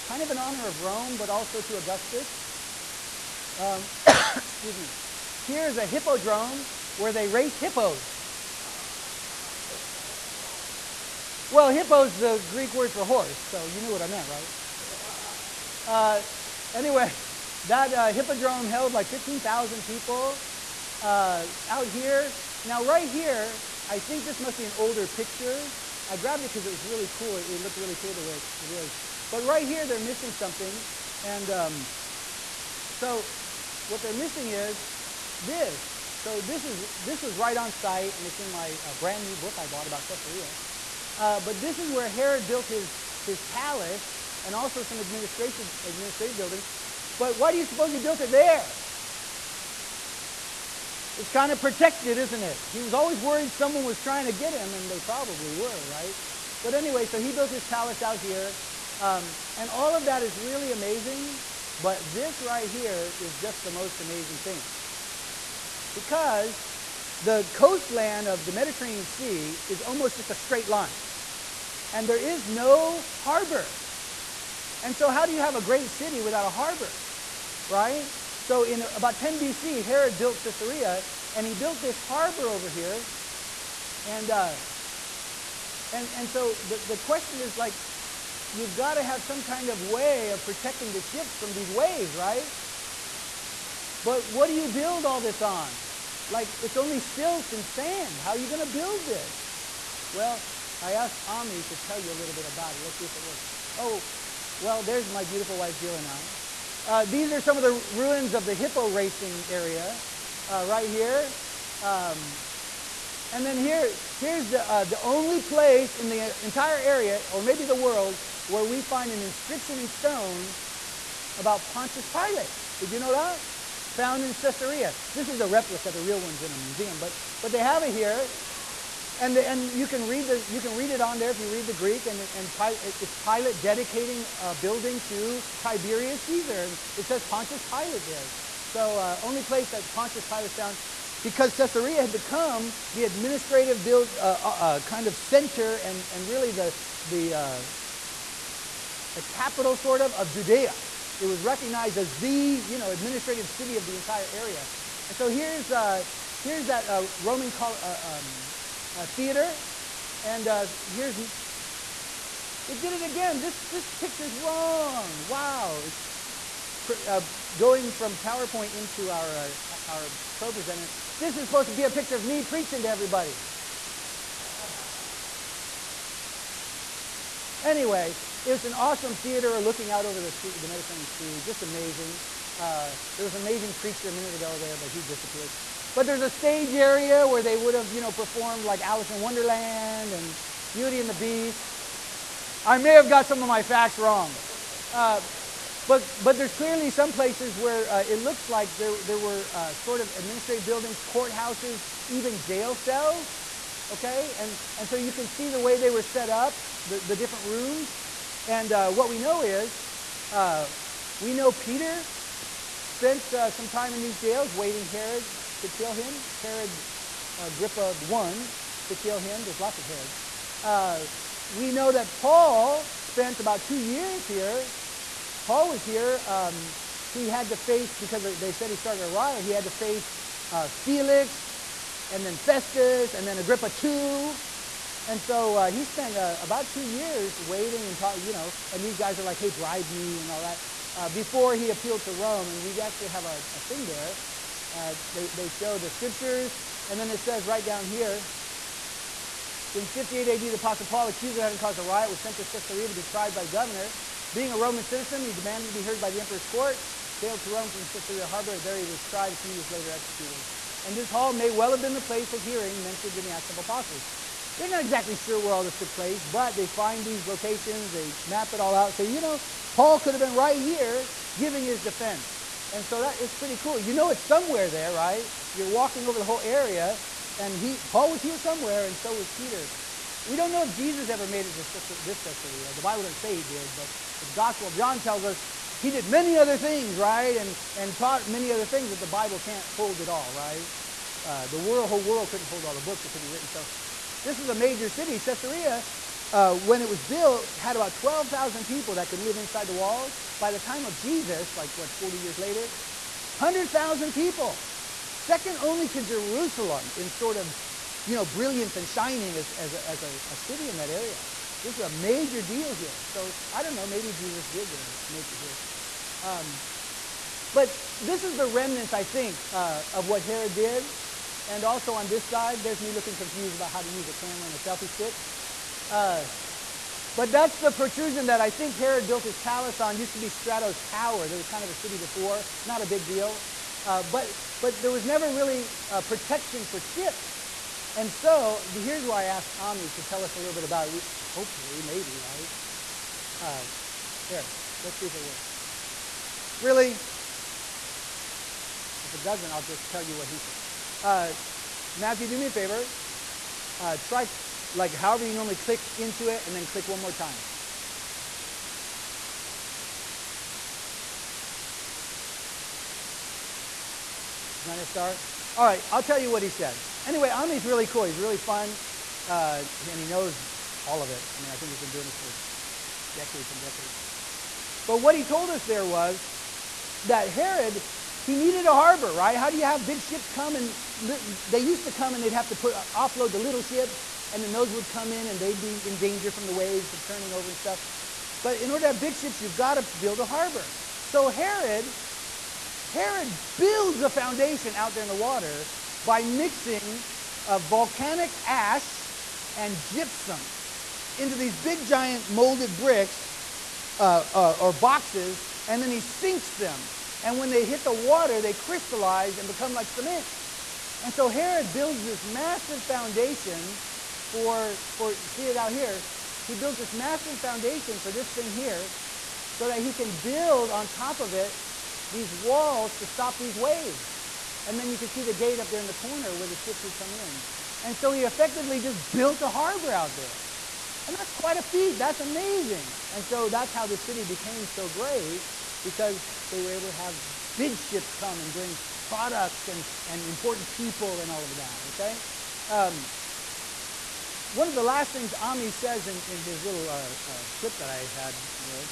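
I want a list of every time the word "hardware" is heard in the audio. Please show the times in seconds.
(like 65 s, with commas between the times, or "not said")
not said.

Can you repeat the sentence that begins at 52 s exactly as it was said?
He was always worried someone was trying to get him, and they probably were, right?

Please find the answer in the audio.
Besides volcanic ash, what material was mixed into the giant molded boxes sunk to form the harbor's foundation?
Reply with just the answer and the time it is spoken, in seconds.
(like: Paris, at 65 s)
gypsum, at 399 s.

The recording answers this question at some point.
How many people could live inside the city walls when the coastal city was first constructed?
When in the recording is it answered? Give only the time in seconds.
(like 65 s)
297 s.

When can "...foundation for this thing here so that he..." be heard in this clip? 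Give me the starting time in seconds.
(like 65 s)
417 s.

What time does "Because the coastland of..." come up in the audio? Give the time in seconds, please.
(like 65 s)
65 s.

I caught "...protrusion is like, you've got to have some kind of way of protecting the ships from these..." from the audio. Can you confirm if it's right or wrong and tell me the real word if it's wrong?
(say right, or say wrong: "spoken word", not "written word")
wrong: "question", not "protrusion".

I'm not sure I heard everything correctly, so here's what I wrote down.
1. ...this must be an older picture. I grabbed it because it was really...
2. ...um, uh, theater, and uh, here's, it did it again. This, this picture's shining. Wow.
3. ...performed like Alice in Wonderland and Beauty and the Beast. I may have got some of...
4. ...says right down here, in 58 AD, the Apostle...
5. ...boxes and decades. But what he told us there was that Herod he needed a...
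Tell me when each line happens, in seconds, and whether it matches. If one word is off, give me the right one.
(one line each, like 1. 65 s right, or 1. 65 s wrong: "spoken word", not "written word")
1. 24 s right
2. 158 s wrong: "wrong", not "shining"
3. 188 s right
4. 247 s right
5. 373 s wrong: "decades", not "boxes".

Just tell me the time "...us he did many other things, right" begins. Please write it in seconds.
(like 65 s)
285 s.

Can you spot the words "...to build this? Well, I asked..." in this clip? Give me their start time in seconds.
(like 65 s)
98 s.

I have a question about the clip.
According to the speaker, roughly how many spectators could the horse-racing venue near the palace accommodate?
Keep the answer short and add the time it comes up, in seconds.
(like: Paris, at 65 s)
15,000, at 19 s.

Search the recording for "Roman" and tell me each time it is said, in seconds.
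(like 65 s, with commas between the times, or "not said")
157 s, 254 s.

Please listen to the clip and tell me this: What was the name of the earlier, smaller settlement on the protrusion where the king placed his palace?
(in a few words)
Strato's Tower.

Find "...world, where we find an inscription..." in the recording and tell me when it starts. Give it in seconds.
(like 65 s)
117 s.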